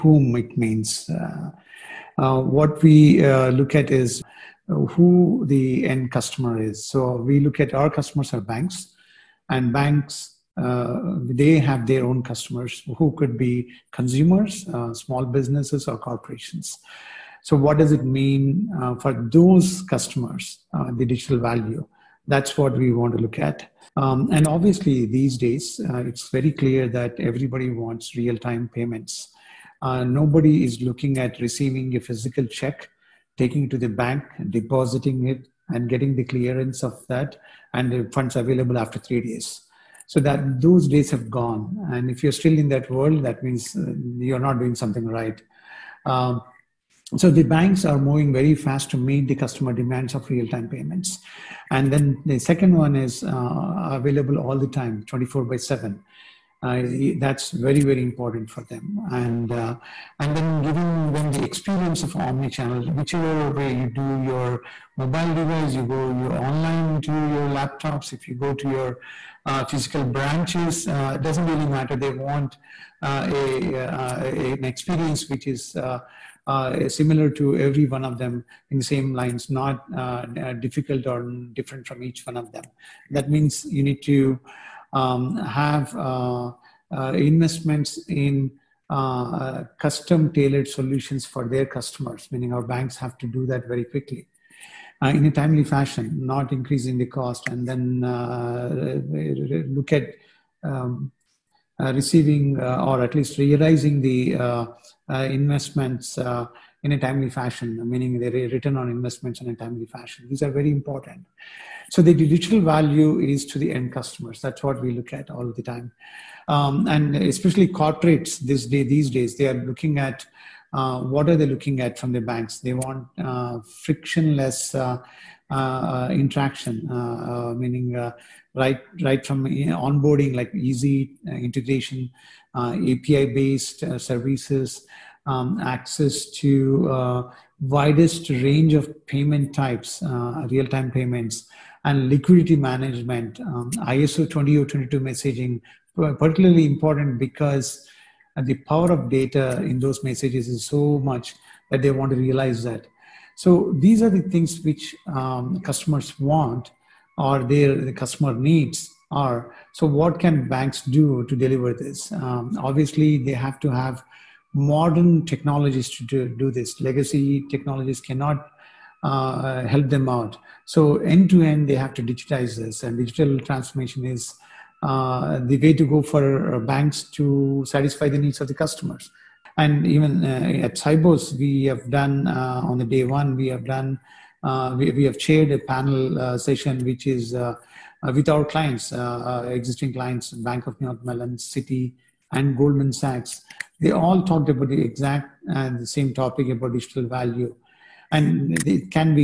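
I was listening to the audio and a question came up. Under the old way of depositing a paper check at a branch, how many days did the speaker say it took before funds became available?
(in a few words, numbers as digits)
3.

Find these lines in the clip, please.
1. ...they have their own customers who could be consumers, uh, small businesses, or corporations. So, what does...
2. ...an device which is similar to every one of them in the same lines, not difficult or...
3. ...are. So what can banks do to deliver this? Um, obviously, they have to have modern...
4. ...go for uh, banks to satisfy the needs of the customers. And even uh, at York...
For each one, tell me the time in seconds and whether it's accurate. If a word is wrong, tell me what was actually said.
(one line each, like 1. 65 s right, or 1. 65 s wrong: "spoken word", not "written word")
1. 11 s right
2. 74 s wrong: "experience", not "device"
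3. 159 s right
4. 175 s wrong: "Sibos", not "York".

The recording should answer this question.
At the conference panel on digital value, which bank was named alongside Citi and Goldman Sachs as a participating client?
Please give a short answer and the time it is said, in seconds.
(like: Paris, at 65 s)
Bank of New York Mellon, at 190 s.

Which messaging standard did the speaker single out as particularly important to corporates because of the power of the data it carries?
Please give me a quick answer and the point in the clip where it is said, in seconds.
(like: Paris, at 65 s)
ISO 22, at 143 s.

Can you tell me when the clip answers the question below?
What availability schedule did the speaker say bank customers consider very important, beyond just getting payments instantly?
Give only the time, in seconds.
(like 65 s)
55 s.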